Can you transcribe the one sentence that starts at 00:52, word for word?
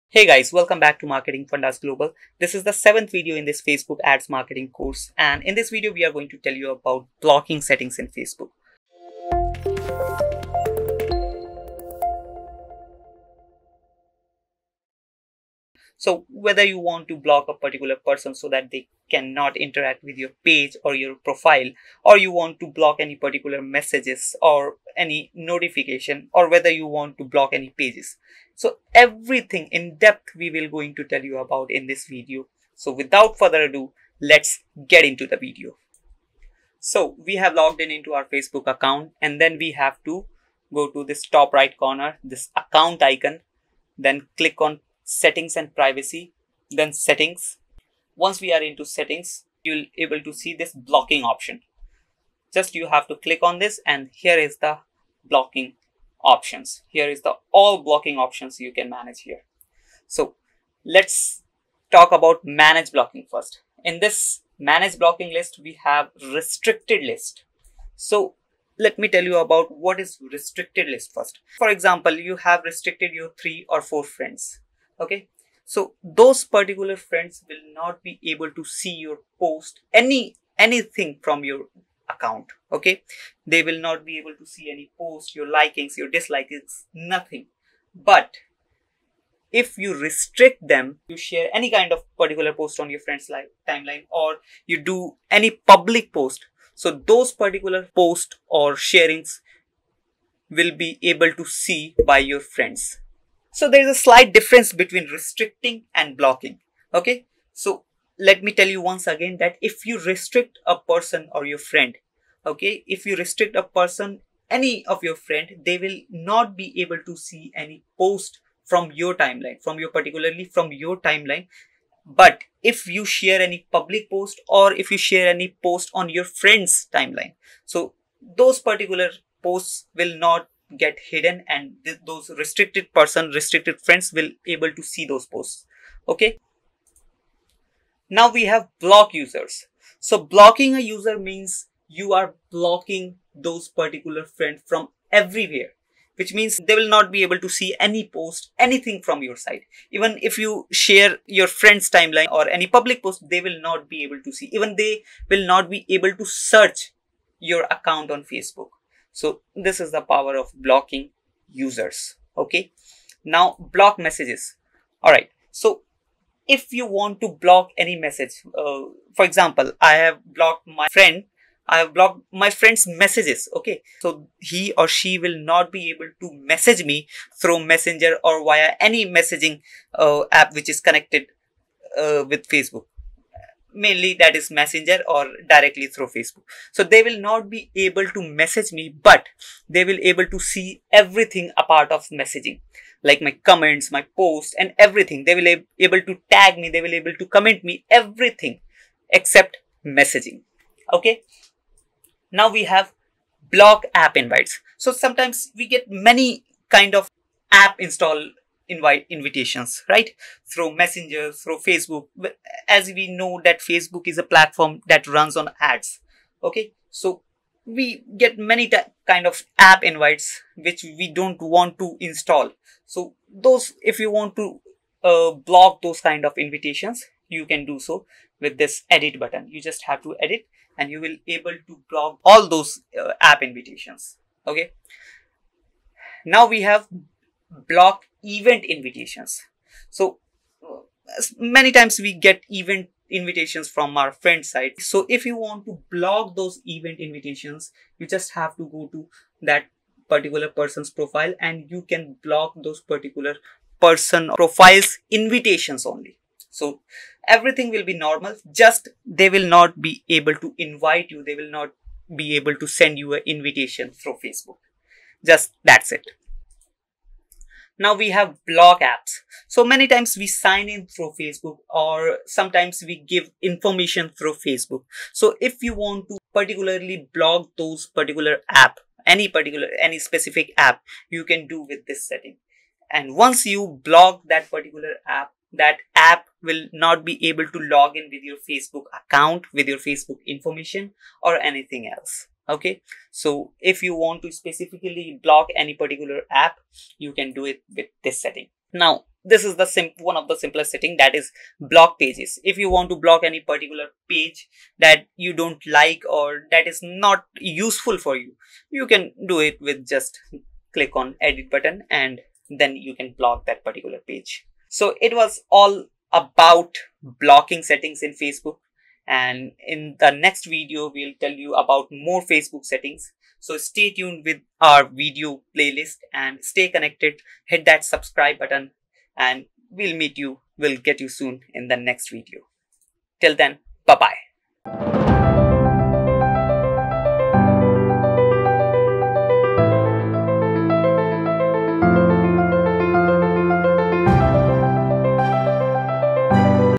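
Just you have to click on this and here is the blocking options.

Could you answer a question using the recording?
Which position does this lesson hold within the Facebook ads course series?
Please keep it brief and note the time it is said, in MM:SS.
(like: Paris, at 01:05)
Seventh, at 00:02.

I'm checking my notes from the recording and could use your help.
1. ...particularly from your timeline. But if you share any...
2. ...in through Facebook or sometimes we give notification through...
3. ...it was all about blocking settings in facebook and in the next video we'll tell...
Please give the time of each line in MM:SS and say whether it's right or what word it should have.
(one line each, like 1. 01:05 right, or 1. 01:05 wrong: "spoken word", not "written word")
1. 01:59 right
2. 04:30 wrong: "information", not "notification"
3. 05:14 right.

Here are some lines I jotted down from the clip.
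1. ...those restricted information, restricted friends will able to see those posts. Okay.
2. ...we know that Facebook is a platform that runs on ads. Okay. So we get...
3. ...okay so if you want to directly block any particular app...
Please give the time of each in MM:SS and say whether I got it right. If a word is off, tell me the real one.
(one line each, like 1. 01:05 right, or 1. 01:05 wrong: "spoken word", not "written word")
1. 02:12 wrong: "person", not "information"
2. 03:32 right
3. 04:52 wrong: "specifically", not "directly".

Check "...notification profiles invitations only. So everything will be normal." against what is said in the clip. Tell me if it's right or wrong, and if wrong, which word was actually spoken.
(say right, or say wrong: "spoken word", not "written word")
wrong: "person", not "notification".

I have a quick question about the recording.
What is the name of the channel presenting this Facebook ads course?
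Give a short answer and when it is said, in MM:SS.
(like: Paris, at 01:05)
Marketing Fundas Global, at 00:01.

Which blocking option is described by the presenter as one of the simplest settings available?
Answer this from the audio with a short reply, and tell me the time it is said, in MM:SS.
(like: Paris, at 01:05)
Block pages, at 05:01.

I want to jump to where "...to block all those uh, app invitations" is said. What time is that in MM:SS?
03:51.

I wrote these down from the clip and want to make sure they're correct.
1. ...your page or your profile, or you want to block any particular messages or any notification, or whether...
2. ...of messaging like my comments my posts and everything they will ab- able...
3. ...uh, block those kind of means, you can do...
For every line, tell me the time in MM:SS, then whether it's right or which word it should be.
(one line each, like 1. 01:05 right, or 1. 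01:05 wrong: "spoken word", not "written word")
1. 00:20 right
2. 03:11 right
3. 03:45 wrong: "invitations", not "means".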